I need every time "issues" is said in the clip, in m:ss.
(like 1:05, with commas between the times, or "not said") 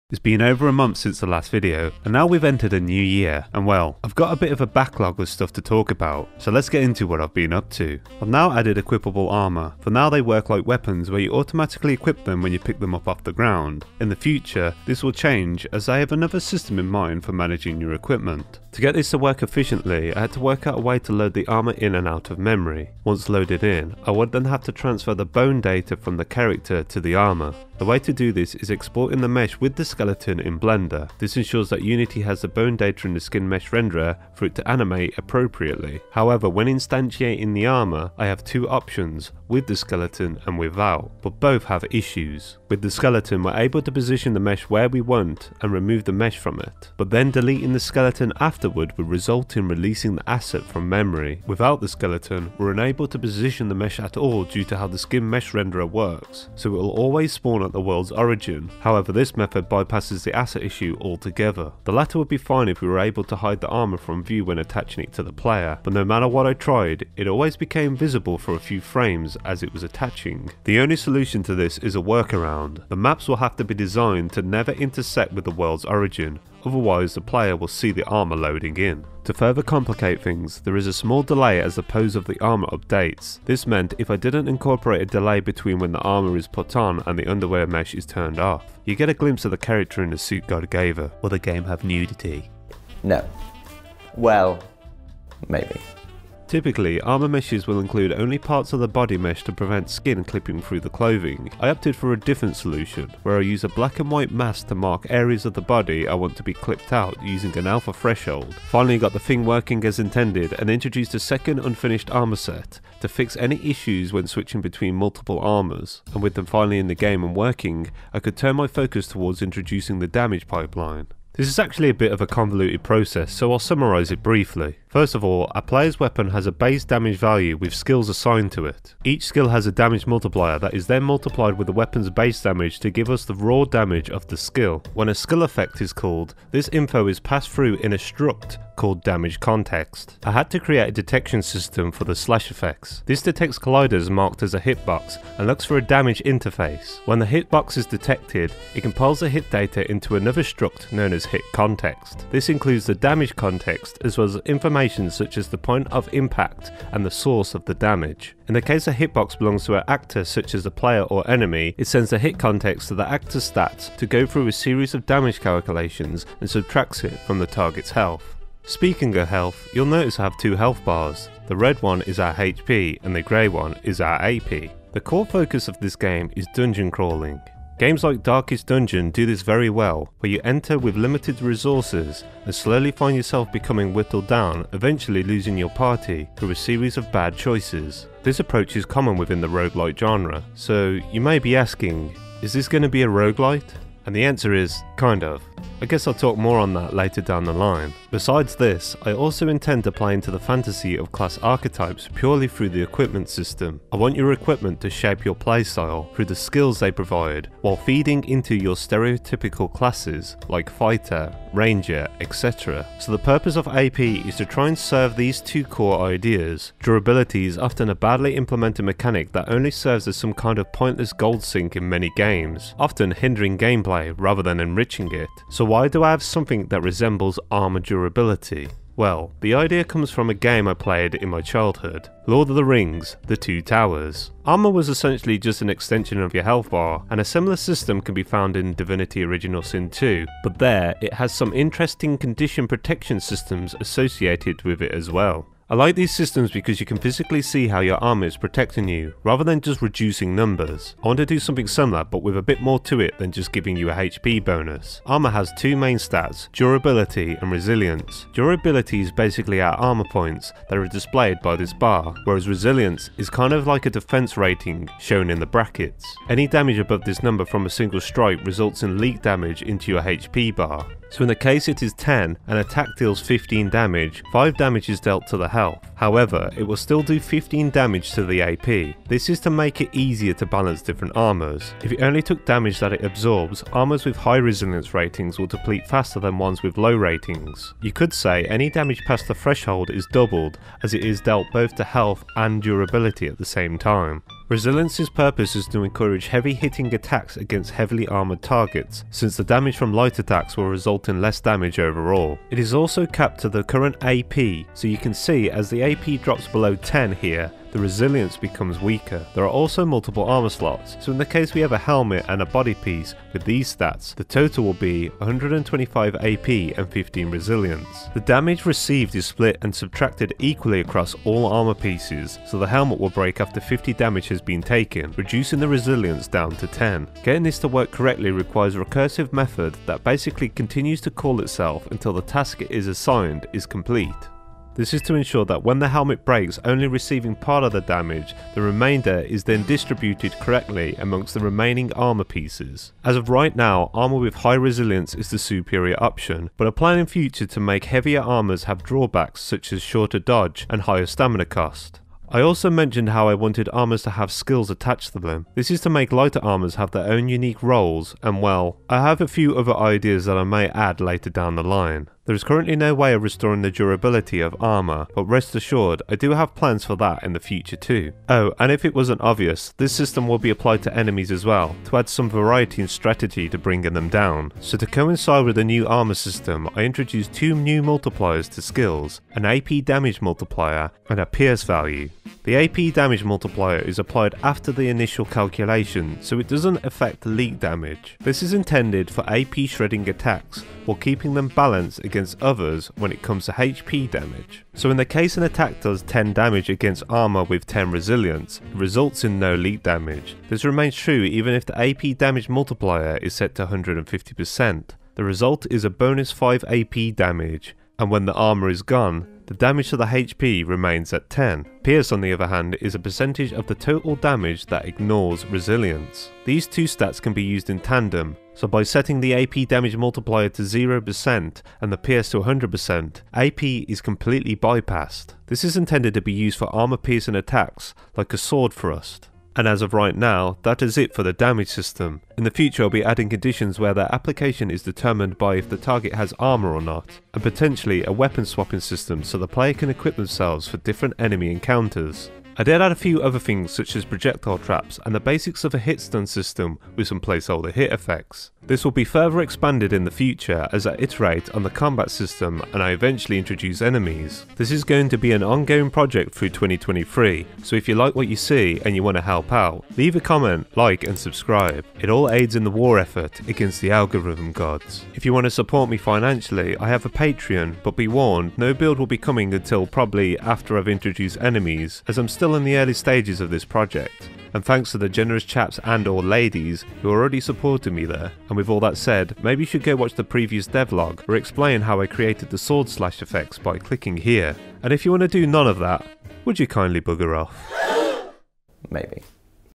0:41, 1:00, 1:53.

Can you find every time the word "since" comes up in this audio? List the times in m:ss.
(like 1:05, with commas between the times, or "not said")
0:00, 4:59.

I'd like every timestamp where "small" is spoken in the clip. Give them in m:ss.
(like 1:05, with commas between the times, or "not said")
1:20.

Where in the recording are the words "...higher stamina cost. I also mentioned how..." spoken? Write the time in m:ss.
5:50.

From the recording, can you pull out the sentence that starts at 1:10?
The only solution to this is a workaround.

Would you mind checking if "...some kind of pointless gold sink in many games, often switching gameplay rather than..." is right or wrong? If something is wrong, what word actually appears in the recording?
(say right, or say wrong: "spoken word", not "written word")
wrong: "hindering", not "switching".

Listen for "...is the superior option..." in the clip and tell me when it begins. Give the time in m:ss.
5:45.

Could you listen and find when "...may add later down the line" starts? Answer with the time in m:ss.
6:00.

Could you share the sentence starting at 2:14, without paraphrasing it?
When a skill effect is called, this info is passed through in a struct called Damage Context.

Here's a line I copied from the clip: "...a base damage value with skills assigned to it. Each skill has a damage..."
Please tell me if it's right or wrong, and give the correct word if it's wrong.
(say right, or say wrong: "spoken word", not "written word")
right.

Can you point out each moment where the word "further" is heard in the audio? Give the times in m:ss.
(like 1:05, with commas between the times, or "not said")
1:19, 7:29.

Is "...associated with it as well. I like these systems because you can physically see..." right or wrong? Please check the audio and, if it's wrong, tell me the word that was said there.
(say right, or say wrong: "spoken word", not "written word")
right.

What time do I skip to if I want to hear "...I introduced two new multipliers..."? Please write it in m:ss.
6:16.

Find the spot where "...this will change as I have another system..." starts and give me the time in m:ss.
0:14.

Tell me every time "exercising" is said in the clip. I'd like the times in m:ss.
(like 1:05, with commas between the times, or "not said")
not said.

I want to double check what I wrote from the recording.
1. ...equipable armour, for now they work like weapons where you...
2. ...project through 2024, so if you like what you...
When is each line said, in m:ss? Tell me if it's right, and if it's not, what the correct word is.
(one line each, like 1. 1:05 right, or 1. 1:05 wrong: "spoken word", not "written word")
1. 0:08 right
2. 7:35 wrong: "2023", not "2024".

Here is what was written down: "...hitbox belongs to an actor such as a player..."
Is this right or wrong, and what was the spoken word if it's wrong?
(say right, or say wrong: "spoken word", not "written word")
right.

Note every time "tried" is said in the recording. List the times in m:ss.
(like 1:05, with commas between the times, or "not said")
1:06.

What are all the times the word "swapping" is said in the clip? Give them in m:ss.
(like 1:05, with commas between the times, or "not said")
7:18.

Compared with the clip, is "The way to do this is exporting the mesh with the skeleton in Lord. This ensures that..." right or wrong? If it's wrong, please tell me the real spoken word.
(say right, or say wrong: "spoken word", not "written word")
wrong: "Blender", not "Lord".